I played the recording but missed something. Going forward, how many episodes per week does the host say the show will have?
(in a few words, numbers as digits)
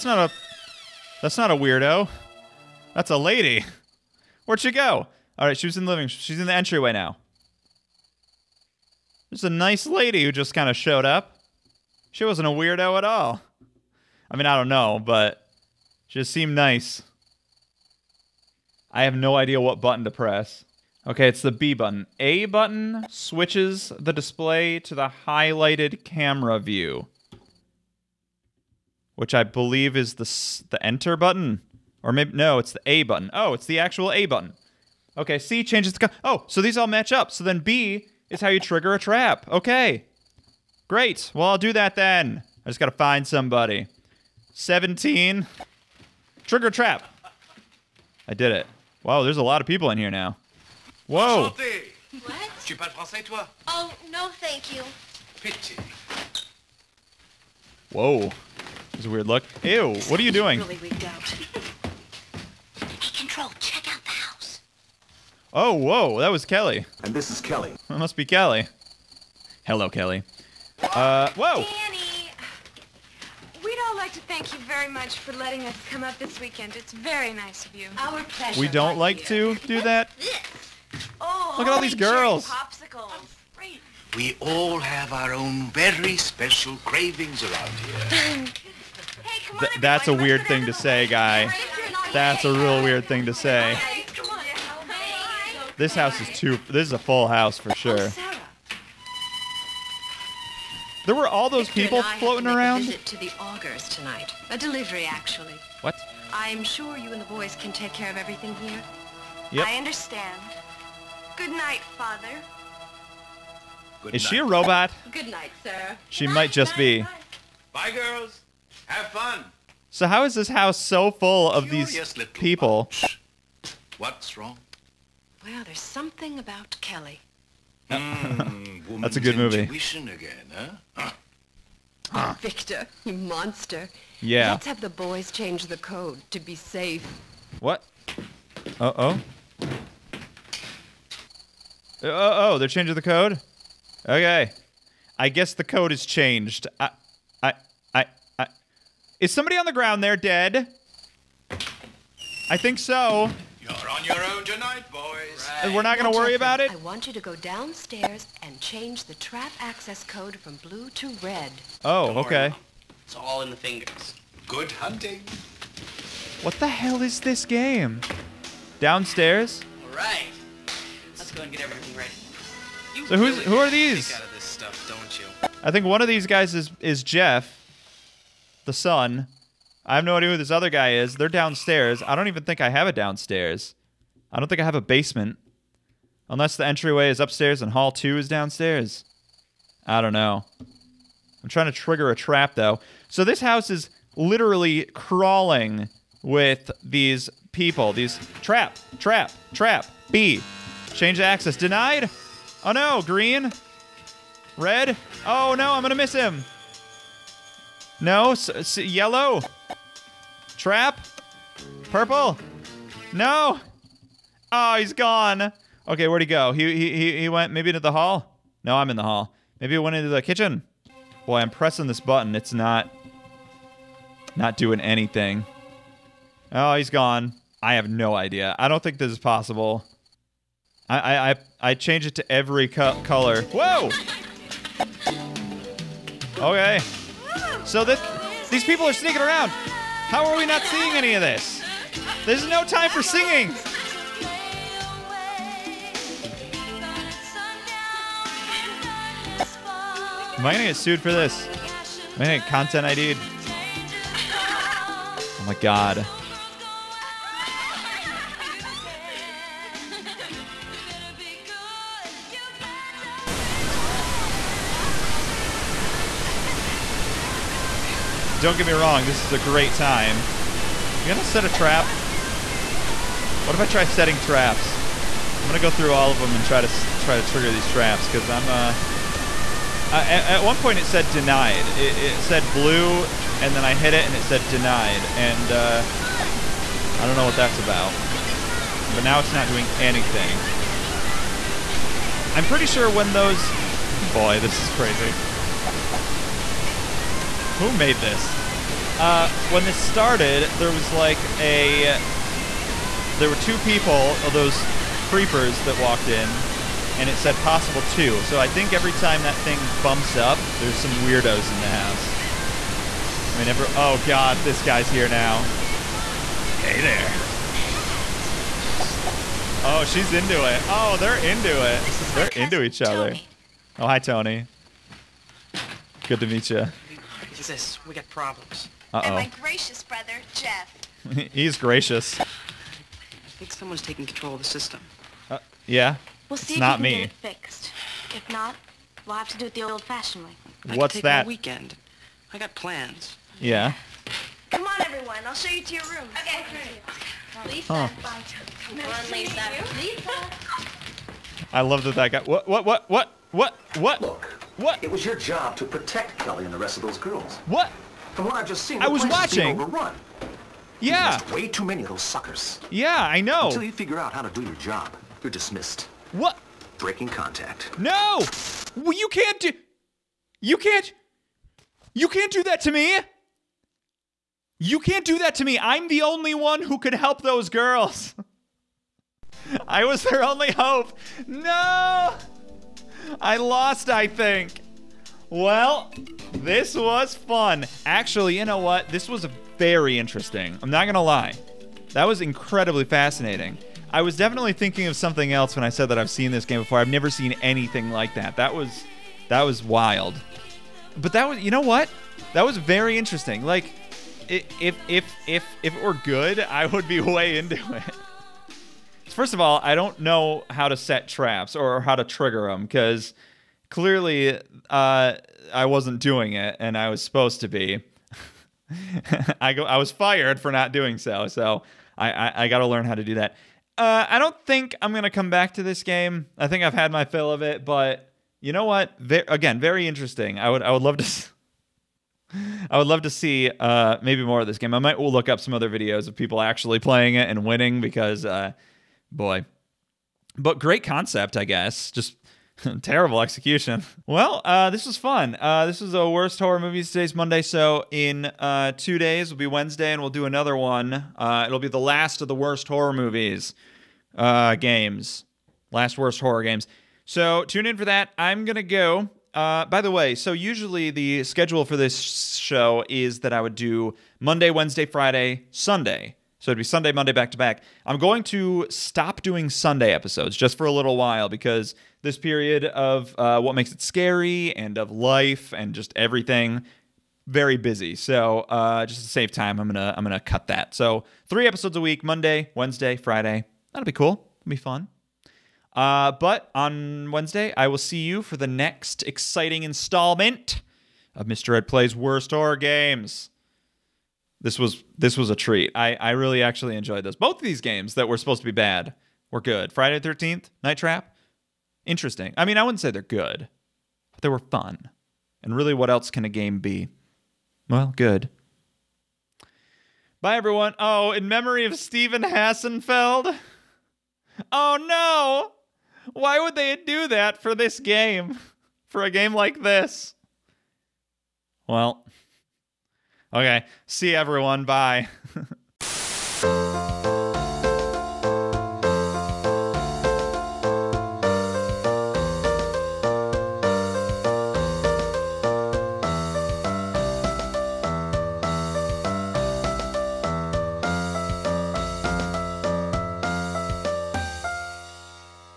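3.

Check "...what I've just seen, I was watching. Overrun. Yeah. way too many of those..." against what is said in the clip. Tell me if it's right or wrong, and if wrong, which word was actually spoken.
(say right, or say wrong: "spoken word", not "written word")
right.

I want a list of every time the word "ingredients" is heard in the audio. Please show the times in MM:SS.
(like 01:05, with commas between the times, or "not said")
not said.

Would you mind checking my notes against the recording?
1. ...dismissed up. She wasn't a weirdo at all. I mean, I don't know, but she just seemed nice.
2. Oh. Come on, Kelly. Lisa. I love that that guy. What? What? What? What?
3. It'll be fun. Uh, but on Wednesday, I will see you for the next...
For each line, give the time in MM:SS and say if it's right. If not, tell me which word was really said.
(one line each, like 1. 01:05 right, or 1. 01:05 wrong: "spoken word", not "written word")
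1. 00:10 wrong: "showed", not "dismissed"
2. 05:47 wrong: "Lisa", not "Kelly"
3. 08:04 right.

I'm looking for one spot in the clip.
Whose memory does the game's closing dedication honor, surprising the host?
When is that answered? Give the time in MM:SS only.
08:31.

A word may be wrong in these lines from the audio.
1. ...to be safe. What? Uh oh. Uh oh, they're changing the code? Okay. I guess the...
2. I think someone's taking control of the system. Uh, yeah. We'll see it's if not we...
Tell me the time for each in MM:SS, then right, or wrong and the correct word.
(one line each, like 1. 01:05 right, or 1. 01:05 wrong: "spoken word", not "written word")
1. 02:16 right
2. 05:32 right.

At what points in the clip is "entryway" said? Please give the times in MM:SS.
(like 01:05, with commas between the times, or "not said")
00:06, 03:06.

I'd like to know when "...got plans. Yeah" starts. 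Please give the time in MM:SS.
05:42.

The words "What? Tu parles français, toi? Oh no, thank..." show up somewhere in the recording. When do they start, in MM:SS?
00:51.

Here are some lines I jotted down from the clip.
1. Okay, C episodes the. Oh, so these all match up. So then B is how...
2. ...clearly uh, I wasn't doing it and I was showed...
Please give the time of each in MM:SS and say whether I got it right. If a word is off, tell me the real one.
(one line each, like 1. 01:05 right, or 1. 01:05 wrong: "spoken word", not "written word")
1. 00:35 wrong: "changes", not "episodes"
2. 06:53 wrong: "supposed", not "showed".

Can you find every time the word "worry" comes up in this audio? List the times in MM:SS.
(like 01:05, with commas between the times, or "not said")
02:36, 02:42.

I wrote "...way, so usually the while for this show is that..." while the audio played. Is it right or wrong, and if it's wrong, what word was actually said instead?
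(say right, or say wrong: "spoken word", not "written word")
wrong: "schedule", not "while".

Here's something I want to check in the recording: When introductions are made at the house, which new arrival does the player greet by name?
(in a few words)
Tony.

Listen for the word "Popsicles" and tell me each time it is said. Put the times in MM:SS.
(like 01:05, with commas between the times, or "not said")
01:22.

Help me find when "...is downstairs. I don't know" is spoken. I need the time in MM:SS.
03:08.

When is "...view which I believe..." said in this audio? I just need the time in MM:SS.
00:26.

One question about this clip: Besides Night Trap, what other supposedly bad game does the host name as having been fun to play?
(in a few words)
Friday the 13th.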